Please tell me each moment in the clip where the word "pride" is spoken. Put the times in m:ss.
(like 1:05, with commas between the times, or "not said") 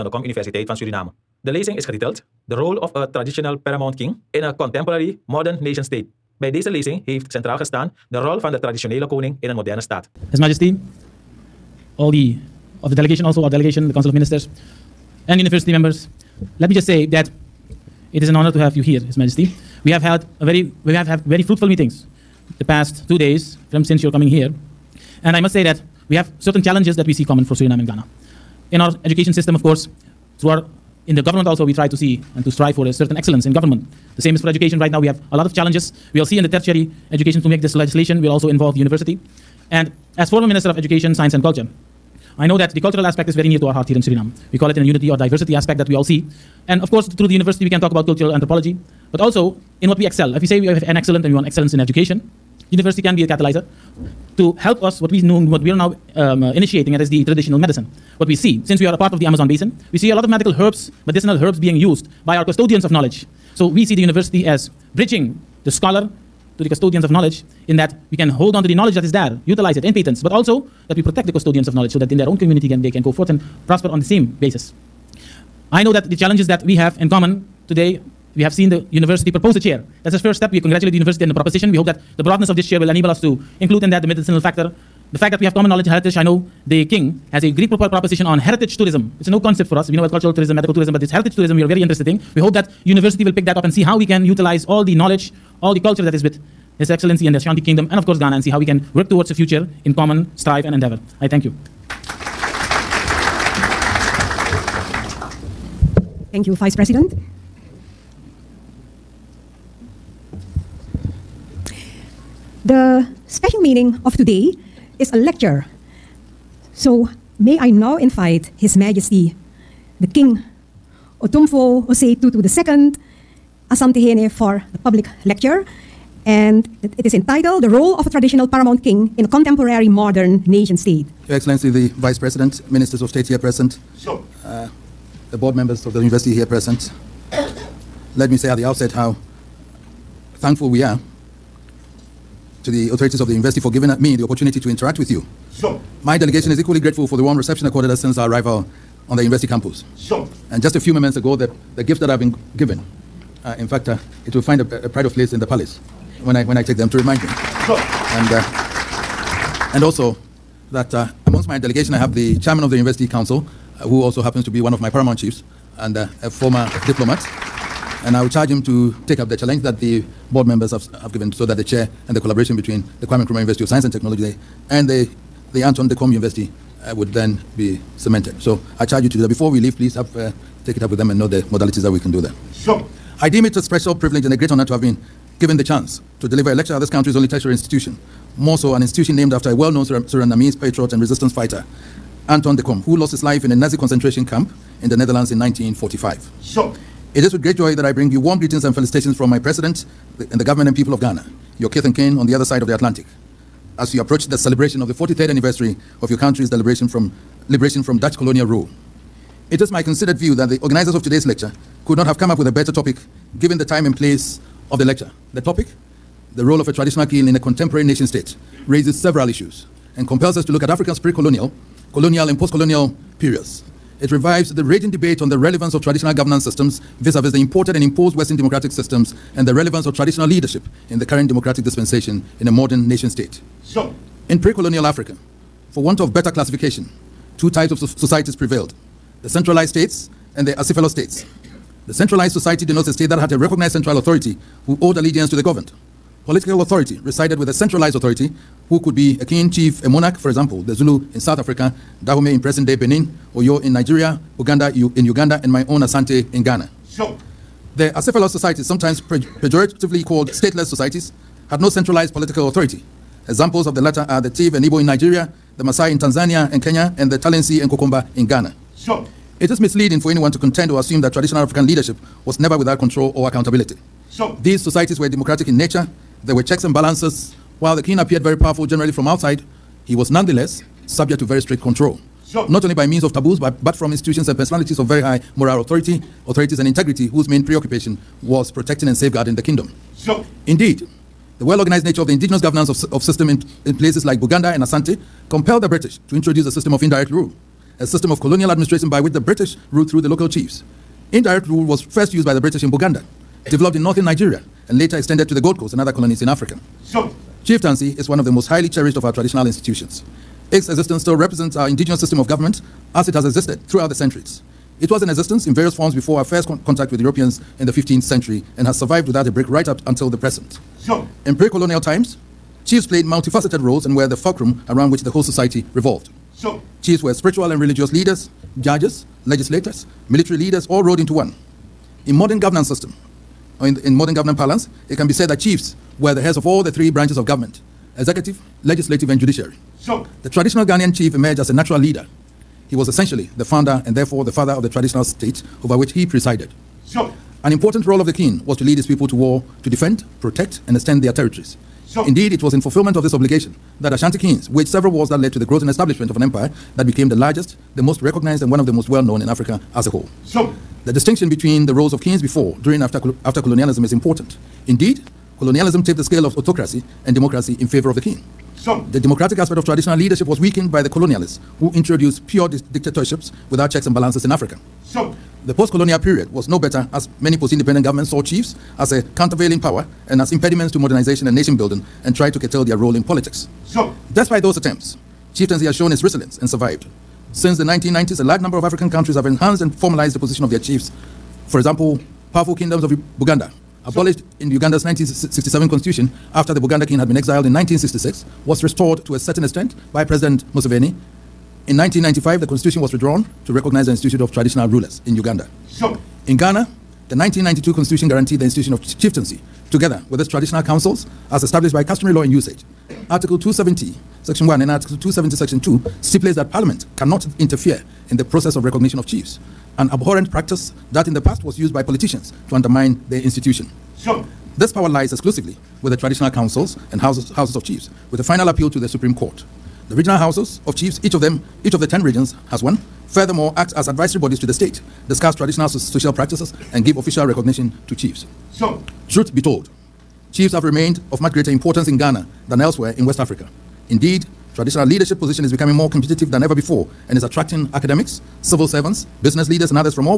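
2:34.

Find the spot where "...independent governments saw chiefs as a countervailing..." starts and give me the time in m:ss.
6:17.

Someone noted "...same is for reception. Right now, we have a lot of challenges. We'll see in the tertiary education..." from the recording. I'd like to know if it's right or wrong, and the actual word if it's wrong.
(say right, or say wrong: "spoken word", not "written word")
wrong: "education", not "reception".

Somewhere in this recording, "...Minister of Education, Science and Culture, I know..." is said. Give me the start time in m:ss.
0:40.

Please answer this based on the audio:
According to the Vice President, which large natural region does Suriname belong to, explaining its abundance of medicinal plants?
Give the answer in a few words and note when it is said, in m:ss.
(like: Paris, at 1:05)
Amazon basin, at 0:59.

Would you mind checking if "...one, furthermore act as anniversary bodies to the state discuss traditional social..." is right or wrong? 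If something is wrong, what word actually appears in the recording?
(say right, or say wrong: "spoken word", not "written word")
wrong: "advisory", not "anniversary".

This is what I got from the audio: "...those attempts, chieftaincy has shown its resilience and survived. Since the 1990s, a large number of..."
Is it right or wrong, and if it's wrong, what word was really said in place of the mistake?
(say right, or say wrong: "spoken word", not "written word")
right.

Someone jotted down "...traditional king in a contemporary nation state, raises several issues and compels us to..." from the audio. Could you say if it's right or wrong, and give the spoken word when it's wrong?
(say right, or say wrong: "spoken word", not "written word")
right.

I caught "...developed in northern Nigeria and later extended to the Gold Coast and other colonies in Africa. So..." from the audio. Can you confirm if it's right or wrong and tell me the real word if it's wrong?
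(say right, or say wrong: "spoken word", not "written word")
right.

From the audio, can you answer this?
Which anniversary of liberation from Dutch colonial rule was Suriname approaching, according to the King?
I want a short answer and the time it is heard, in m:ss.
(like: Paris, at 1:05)
43rd, at 3:24.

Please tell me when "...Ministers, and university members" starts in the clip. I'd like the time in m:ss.
0:14.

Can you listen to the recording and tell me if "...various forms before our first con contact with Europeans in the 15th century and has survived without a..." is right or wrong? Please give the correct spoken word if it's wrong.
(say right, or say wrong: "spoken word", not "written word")
right.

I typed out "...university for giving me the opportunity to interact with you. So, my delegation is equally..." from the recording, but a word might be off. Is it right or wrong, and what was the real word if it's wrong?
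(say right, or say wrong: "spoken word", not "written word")
right.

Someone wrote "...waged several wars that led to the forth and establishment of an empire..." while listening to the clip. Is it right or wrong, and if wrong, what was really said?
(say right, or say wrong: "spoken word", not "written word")
wrong: "growth", not "forth".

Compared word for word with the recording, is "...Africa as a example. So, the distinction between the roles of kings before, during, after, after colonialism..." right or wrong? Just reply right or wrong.
wrong.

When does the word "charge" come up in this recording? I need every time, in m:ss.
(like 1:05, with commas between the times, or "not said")
2:48, 2:58.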